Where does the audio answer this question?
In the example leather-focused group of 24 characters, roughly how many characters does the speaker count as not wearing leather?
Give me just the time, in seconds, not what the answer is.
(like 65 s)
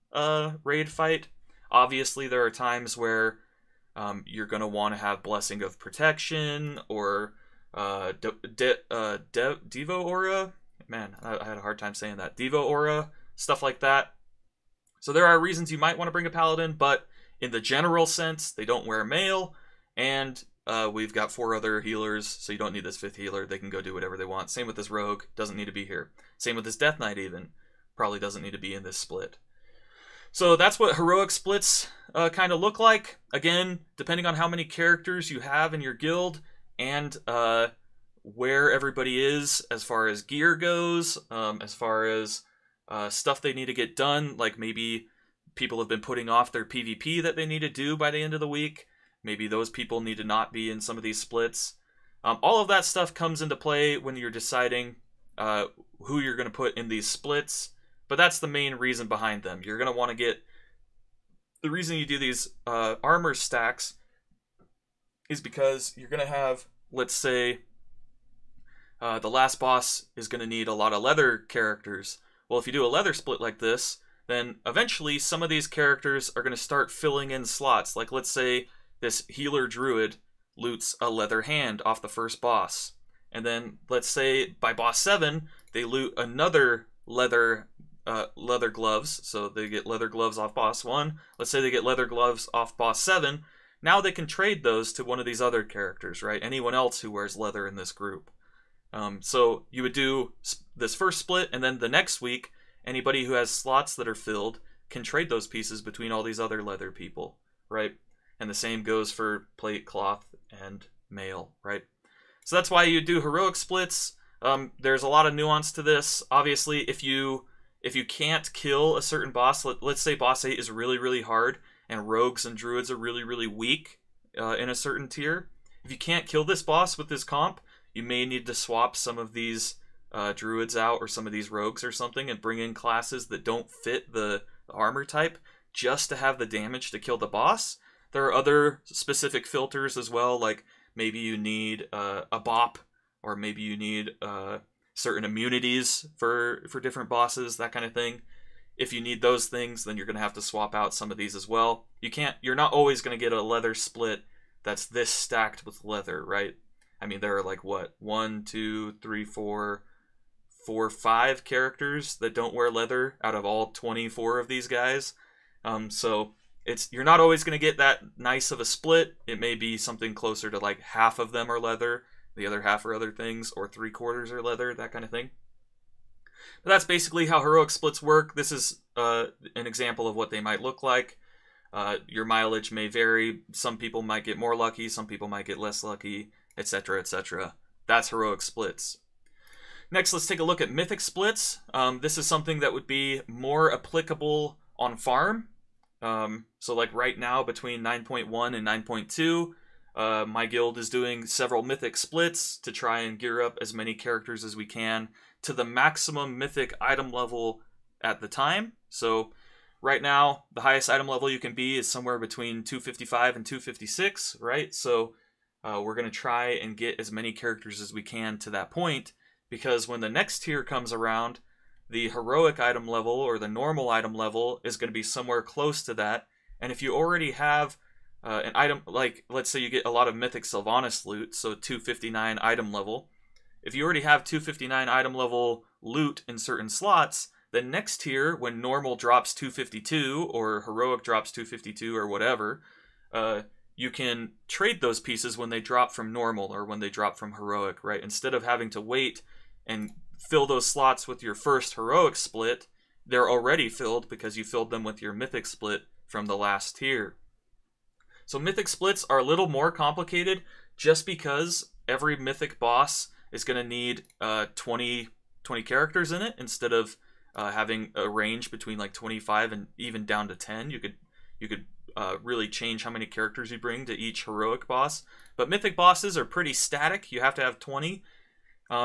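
160 s.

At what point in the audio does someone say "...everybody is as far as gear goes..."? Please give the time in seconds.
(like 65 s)
38 s.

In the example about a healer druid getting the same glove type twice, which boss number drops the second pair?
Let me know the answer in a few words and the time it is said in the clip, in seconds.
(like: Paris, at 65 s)
7, at 84 s.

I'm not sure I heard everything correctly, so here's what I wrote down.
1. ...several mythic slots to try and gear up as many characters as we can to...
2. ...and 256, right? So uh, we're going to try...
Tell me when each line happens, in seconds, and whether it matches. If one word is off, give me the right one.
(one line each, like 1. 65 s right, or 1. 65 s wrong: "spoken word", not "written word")
1. 201 s wrong: "splits", not "slots"
2. 213 s right.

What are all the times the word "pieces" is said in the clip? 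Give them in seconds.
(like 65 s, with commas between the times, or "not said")
105 s, 244 s.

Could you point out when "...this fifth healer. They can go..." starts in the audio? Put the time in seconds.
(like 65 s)
22 s.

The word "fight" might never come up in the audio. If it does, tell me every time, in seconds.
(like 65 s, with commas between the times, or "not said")
0 s.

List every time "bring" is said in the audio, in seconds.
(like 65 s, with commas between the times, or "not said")
16 s, 132 s, 273 s.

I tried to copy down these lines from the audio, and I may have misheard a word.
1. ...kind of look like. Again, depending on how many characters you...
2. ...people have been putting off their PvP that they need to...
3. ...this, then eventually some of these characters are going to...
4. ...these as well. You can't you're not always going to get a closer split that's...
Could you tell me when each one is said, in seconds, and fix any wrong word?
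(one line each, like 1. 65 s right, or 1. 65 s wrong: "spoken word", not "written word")
1. 32 s right
2. 45 s right
3. 73 s right
4. 151 s wrong: "leather", not "closer".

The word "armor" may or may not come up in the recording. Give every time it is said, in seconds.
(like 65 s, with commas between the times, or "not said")
63 s, 134 s.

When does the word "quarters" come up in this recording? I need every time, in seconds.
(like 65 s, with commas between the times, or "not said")
173 s.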